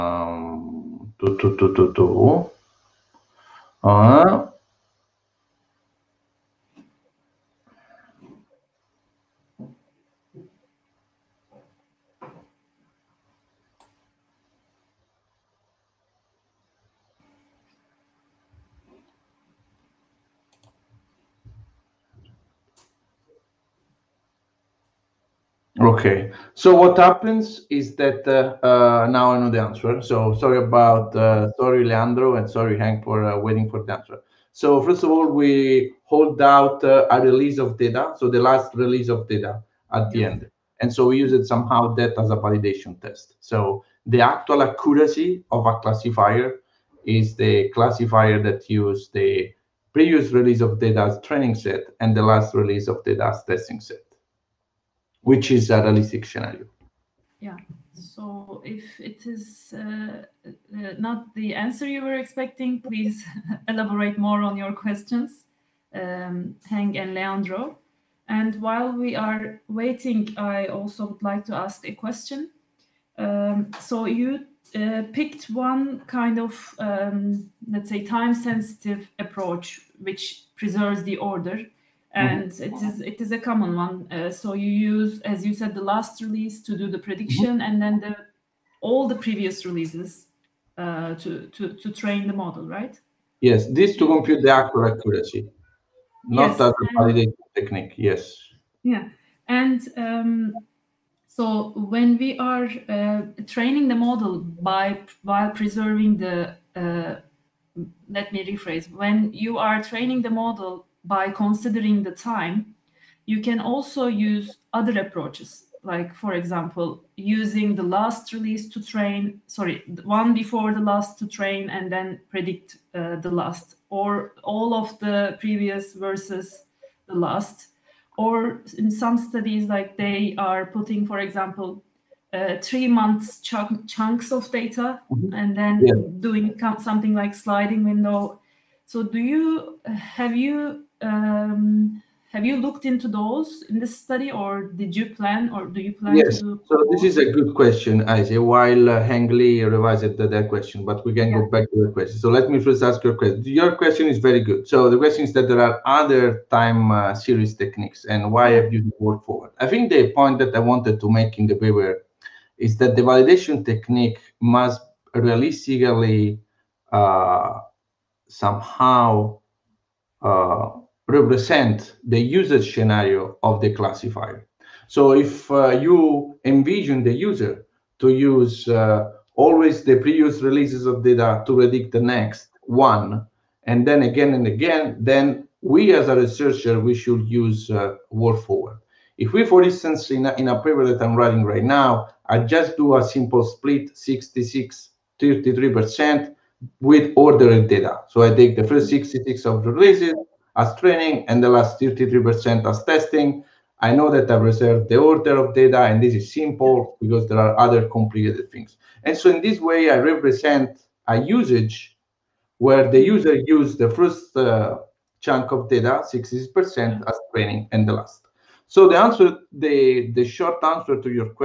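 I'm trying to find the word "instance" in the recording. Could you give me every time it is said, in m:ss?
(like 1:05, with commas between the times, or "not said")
3:09.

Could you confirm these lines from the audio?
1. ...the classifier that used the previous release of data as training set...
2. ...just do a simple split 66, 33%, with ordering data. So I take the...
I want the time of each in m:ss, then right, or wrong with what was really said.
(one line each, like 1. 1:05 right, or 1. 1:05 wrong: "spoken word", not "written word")
1. 0:47 right
2. 3:12 right.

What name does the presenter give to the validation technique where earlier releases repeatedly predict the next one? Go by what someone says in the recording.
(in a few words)
walk forward.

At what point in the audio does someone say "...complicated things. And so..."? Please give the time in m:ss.
3:27.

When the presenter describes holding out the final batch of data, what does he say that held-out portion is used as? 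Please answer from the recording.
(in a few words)
validation test.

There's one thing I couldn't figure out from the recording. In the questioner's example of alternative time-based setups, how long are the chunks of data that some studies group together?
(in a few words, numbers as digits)
three months.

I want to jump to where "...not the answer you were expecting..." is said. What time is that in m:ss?
1:00.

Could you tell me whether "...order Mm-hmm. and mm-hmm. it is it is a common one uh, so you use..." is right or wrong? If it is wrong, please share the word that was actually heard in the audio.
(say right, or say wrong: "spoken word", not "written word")
right.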